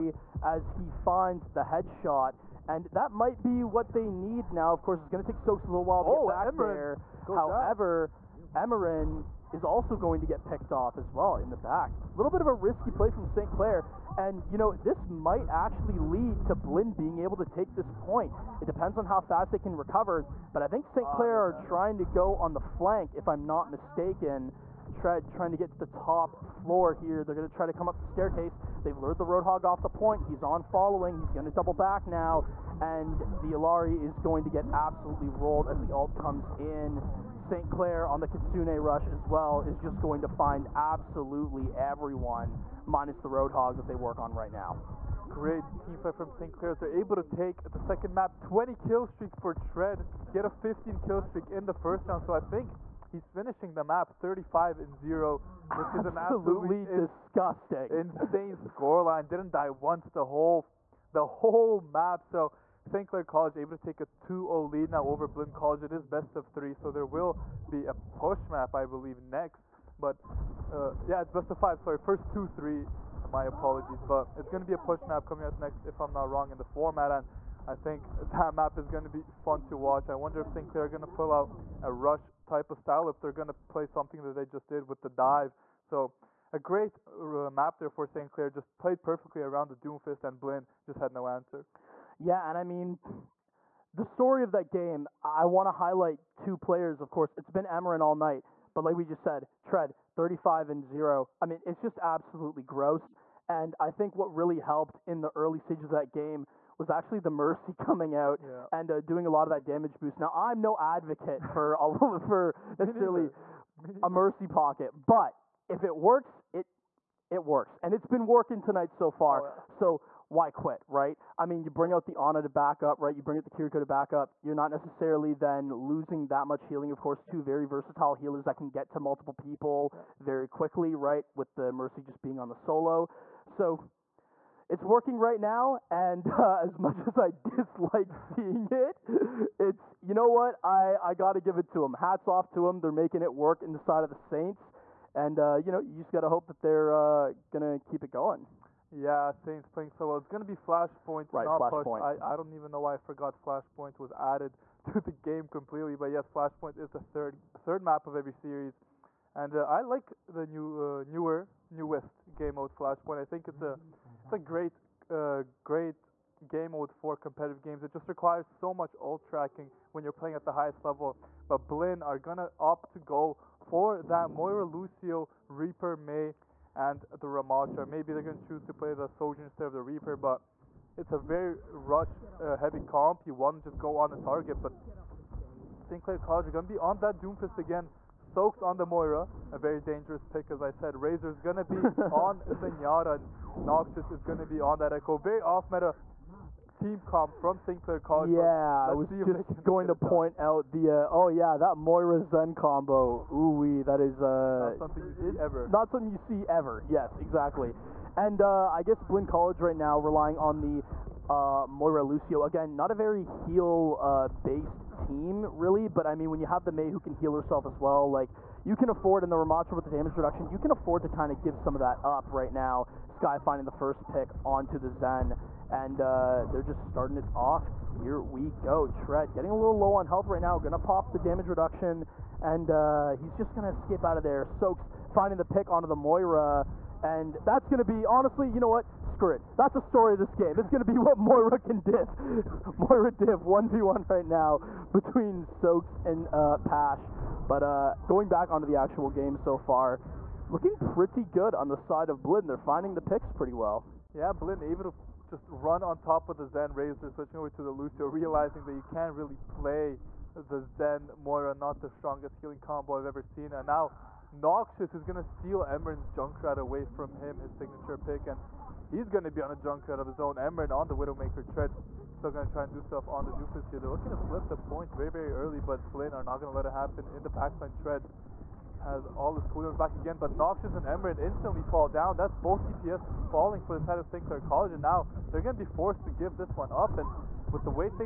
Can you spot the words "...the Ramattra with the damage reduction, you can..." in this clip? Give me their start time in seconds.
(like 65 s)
219 s.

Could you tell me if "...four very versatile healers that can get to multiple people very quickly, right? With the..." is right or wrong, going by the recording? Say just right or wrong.
wrong.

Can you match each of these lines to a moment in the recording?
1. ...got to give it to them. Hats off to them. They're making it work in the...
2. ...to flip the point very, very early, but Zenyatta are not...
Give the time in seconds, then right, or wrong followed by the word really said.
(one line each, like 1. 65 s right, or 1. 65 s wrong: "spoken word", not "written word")
1. 141 s right
2. 274 s wrong: "Blinn", not "Zenyatta".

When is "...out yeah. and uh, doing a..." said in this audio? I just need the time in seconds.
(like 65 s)
108 s.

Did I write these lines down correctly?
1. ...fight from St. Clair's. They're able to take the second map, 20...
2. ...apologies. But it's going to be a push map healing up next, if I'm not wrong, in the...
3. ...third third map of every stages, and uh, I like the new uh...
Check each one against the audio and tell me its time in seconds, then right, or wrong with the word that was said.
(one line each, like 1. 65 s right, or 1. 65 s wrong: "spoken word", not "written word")
1. 45 s right
2. 73 s wrong: "coming", not "healing"
3. 156 s wrong: "series", not "stages".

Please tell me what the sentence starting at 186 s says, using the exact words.
Clair College are going to be on that Doomfist again.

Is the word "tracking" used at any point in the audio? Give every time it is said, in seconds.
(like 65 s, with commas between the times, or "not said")
169 s.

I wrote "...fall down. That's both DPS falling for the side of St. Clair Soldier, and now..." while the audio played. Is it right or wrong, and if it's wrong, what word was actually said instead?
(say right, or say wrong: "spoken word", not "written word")
wrong: "College", not "Soldier".